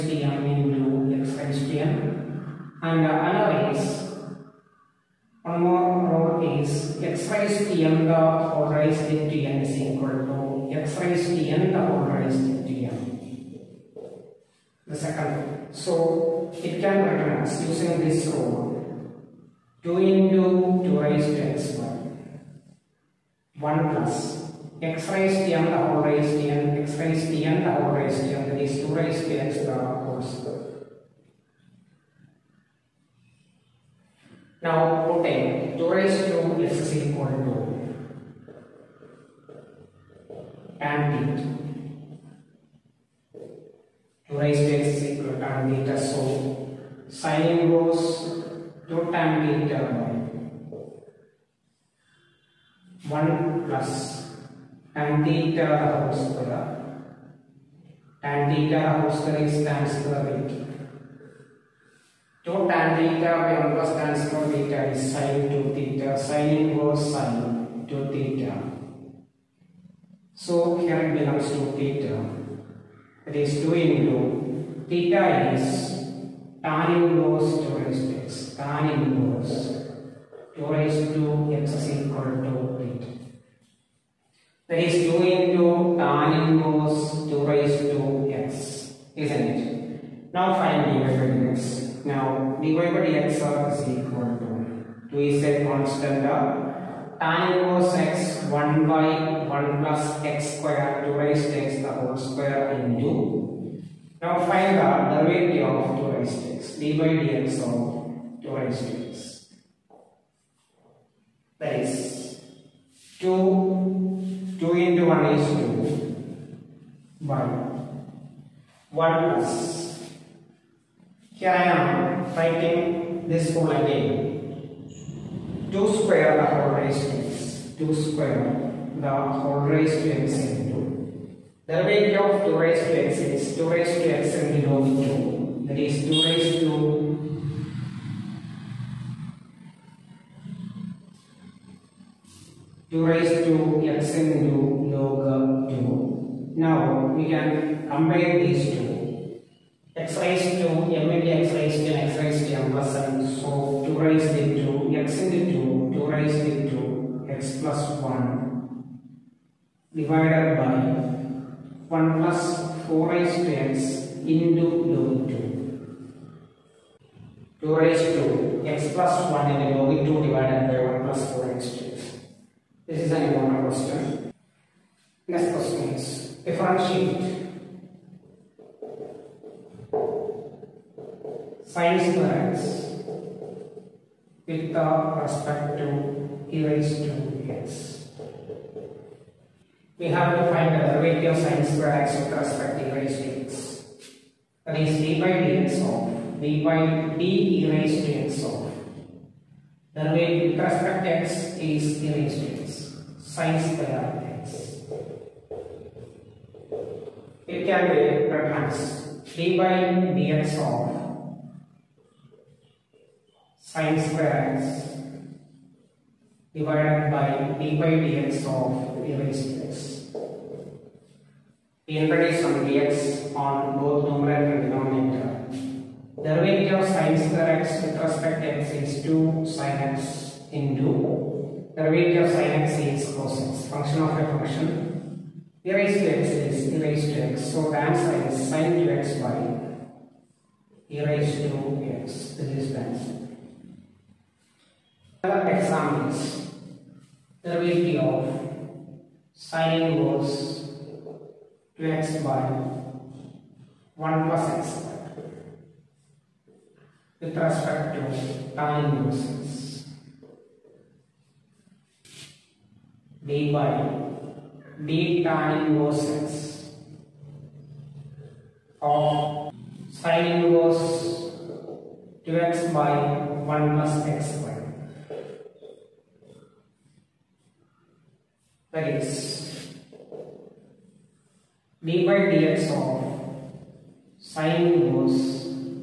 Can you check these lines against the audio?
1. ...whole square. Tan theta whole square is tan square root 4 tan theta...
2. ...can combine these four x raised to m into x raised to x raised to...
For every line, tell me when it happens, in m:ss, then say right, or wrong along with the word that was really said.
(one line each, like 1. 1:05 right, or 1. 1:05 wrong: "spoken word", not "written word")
1. 0:55 wrong: "2", not "4"
2. 2:27 wrong: "two", not "four".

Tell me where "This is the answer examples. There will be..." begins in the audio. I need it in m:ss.
4:02.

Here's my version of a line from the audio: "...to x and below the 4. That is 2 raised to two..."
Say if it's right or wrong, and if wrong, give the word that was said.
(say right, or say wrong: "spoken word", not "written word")
wrong: "2", not "4".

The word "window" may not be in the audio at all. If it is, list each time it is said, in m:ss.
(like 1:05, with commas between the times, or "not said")
not said.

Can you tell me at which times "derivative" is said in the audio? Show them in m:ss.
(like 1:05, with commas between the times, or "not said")
1:45, 3:10, 3:19, 3:46, 3:51.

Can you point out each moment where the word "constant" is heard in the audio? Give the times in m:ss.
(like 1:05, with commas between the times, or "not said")
1:35.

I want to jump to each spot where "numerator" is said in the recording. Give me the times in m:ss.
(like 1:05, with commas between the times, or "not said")
3:44.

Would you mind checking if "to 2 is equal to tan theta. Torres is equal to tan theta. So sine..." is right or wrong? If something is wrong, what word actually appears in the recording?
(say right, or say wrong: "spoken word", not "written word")
right.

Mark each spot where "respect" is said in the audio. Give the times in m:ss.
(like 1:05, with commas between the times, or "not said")
3:05, 3:12, 3:20, 3:47, 4:17.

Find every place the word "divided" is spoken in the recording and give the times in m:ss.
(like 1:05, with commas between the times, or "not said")
2:39, 2:50, 3:36.